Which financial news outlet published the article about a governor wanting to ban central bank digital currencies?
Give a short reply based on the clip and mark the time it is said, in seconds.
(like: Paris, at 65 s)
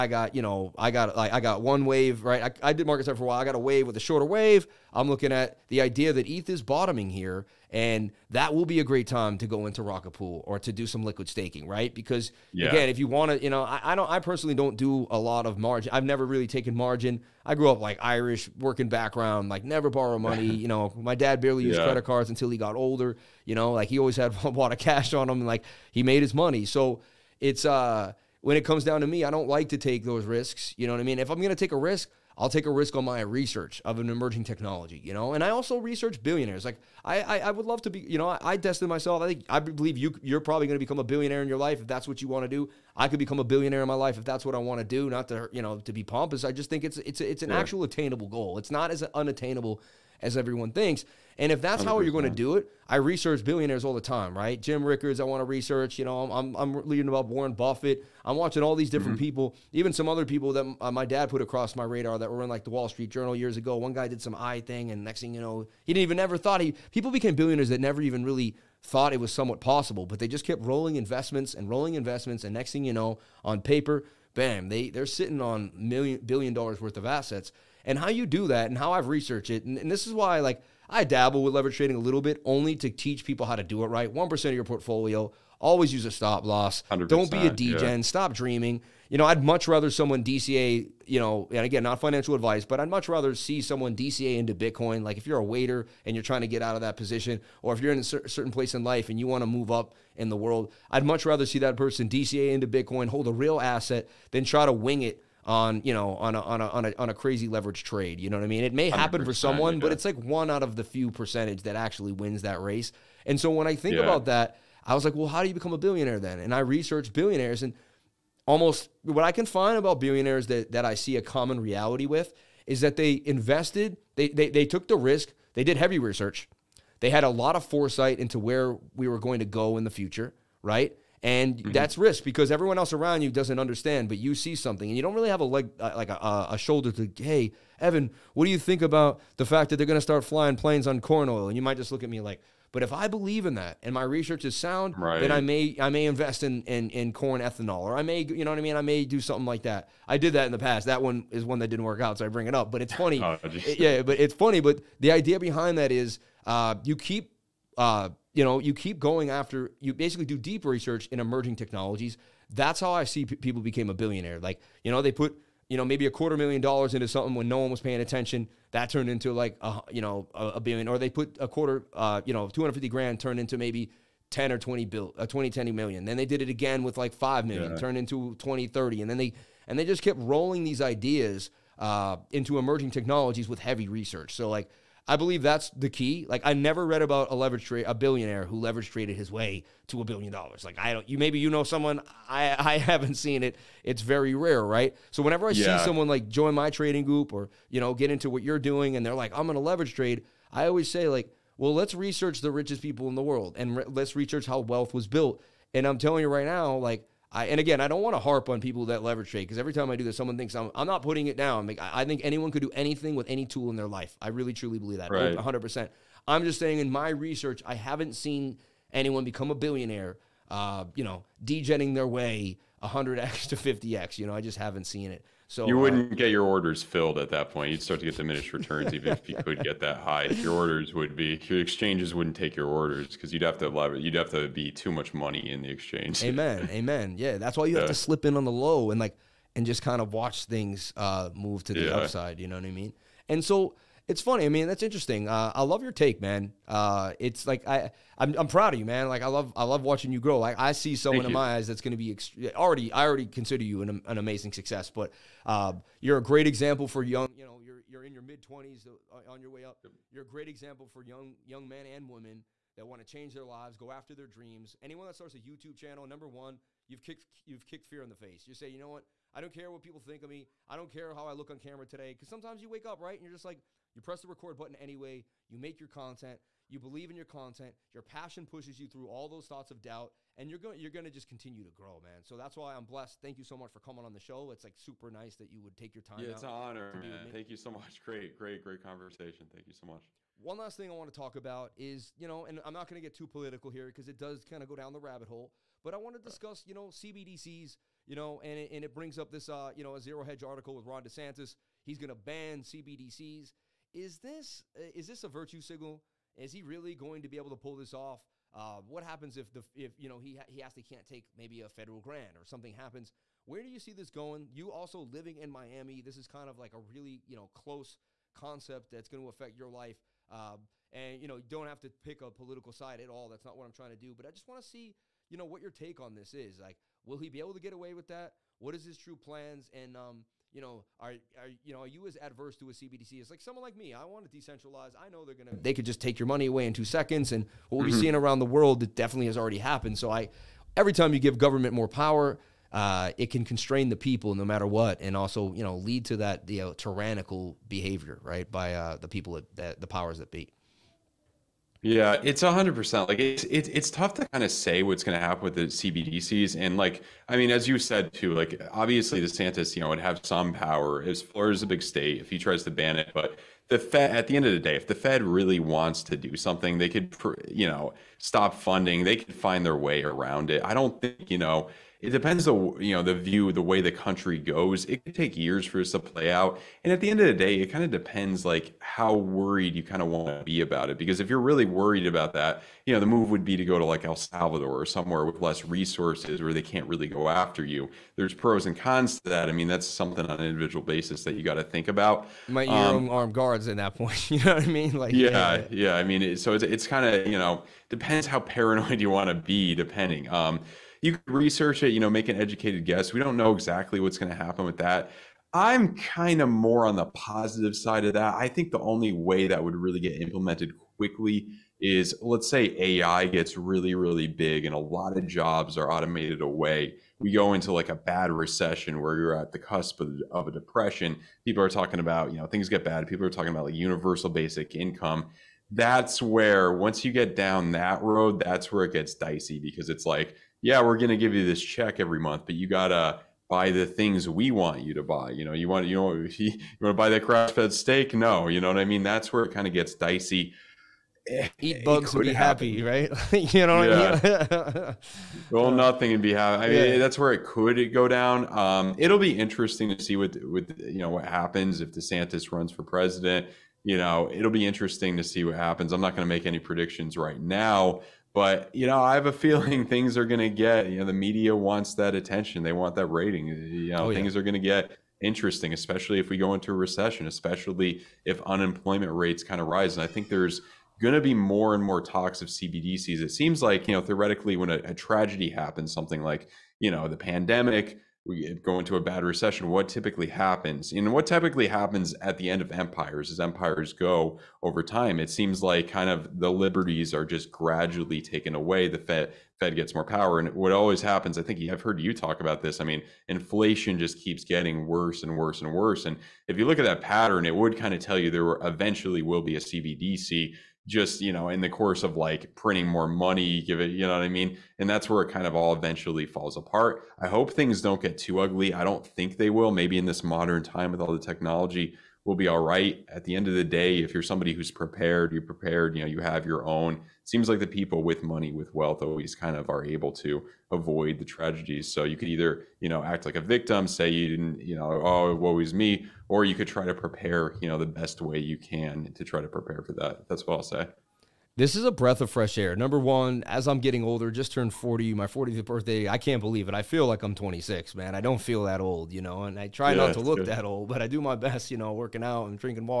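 Zero Hedge, at 300 s.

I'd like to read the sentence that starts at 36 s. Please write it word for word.
Like I, I, I would love to be, you know, I, I tested myself.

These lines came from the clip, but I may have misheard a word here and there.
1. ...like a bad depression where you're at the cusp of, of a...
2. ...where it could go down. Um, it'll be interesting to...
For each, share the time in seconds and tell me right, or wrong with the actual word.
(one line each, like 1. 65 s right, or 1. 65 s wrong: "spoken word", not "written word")
1. 417 s wrong: "recession", not "depression"
2. 447 s right.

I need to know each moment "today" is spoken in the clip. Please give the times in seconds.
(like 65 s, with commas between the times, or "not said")
271 s.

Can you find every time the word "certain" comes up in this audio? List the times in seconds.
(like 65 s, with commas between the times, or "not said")
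98 s.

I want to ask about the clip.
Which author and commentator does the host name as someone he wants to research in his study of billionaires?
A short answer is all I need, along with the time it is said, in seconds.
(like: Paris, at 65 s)
Jim Rickards, at 54 s.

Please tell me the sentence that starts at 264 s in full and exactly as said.
Anyone that starts a YouTube channel, number one, you've kicked you've kicked fear in the face.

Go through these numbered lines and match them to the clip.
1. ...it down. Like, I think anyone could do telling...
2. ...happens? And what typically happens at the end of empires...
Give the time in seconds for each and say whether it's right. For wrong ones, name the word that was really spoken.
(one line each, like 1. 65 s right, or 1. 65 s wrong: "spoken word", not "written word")
1. 211 s wrong: "anything", not "telling"
2. 480 s right.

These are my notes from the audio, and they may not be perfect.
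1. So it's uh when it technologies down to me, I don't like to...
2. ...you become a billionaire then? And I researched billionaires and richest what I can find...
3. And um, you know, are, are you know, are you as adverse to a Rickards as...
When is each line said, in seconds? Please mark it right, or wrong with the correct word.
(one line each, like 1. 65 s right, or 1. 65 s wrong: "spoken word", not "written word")
1. 26 s wrong: "comes", not "technologies"
2. 115 s wrong: "almost", not "richest"
3. 329 s wrong: "CBDC", not "Rickards".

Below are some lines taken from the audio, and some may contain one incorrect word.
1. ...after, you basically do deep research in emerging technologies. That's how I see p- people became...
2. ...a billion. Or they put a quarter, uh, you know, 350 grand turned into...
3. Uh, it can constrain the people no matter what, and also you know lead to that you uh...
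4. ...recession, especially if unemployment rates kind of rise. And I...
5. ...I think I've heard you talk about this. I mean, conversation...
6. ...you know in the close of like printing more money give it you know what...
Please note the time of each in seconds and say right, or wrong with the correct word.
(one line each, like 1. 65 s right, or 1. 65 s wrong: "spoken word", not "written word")
1. 159 s right
2. 170 s wrong: "250", not "350"
3. 342 s right
4. 466 s right
5. 491 s wrong: "inflation", not "conversation"
6. 501 s wrong: "course", not "close".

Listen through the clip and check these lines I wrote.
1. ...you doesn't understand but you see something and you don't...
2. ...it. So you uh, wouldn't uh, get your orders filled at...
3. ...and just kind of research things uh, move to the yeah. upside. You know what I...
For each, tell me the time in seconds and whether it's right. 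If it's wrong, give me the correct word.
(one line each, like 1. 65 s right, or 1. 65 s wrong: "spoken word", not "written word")
1. 133 s right
2. 225 s right
3. 239 s wrong: "watch", not "research".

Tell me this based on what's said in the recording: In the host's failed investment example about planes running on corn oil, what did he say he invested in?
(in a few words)
corn ethanol.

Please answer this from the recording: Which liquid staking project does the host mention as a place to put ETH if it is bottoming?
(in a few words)
Rocket Pool.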